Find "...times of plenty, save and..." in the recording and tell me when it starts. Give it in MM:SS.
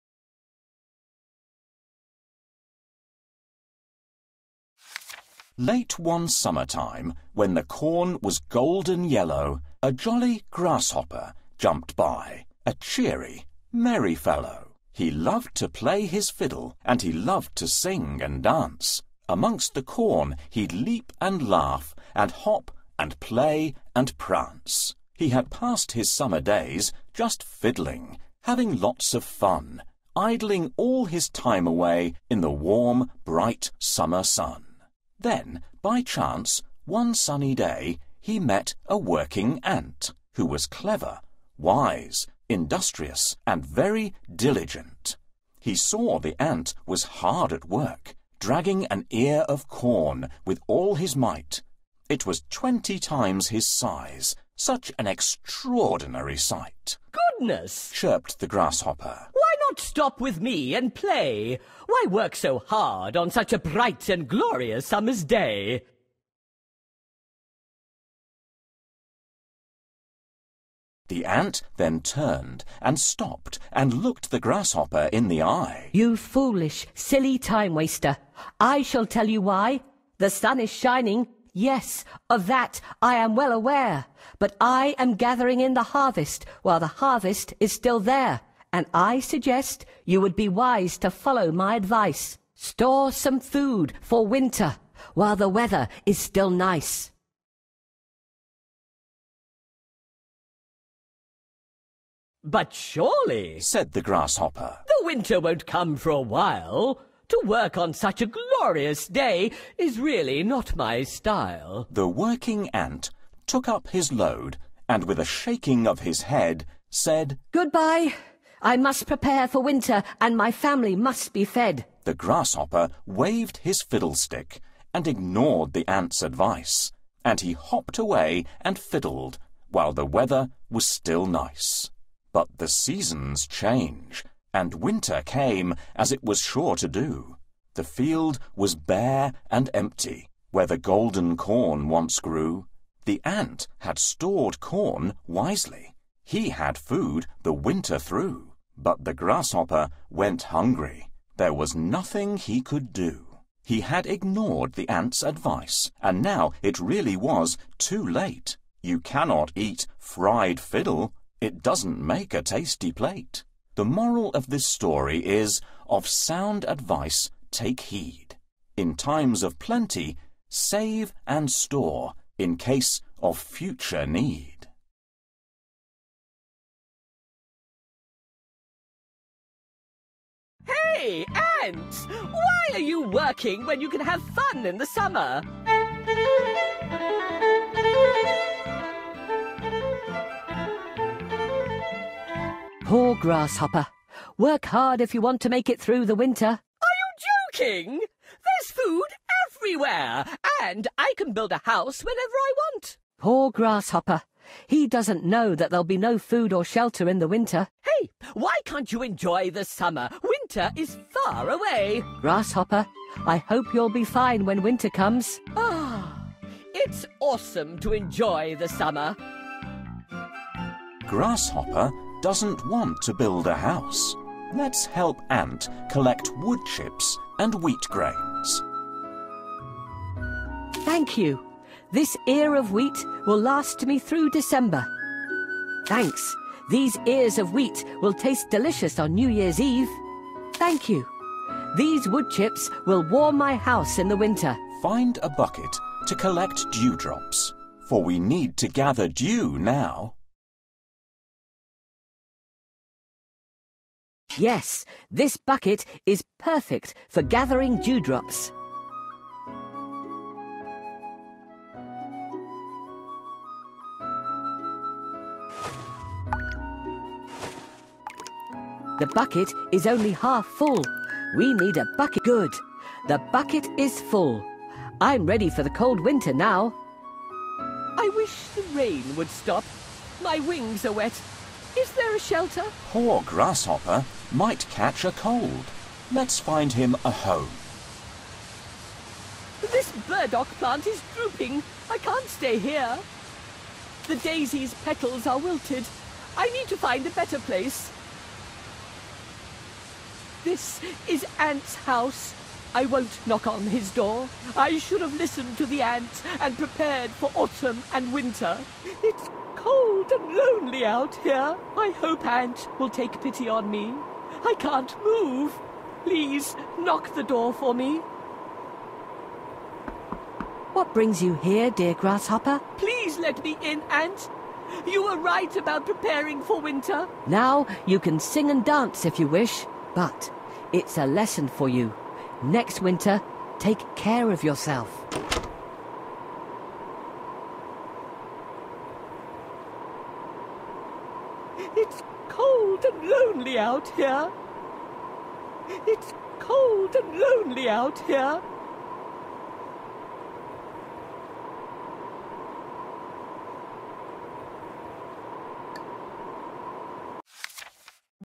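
02:48.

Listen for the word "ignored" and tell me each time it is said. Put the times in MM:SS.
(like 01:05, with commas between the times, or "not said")
02:05, 02:34.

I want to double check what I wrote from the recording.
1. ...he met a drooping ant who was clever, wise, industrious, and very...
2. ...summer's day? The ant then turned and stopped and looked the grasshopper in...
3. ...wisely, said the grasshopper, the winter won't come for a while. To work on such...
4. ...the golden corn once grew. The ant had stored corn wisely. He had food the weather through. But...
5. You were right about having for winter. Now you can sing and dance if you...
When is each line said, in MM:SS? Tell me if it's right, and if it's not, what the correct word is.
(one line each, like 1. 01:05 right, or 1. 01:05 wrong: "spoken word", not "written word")
1. 00:38 wrong: "working", not "drooping"
2. 01:04 right
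3. 01:42 wrong: "surely", not "wisely"
4. 02:20 wrong: "winter", not "weather"
5. 05:24 wrong: "preparing", not "having".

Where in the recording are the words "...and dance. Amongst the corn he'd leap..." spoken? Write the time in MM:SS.
00:18.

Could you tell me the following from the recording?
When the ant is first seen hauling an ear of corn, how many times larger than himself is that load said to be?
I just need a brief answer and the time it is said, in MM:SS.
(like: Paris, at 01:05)
20, at 00:52.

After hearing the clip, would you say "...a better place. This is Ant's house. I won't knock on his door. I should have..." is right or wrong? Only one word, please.
right.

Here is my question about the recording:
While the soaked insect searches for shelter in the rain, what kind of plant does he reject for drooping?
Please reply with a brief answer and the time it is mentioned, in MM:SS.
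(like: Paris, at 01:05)
burdock, at 04:50.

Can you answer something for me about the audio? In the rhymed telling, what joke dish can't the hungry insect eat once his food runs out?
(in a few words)
fried fiddle.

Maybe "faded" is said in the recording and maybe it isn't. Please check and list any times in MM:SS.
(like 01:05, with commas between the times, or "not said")
not said.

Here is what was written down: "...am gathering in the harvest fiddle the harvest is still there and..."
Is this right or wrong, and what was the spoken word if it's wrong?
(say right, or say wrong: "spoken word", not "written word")
wrong: "while", not "fiddle".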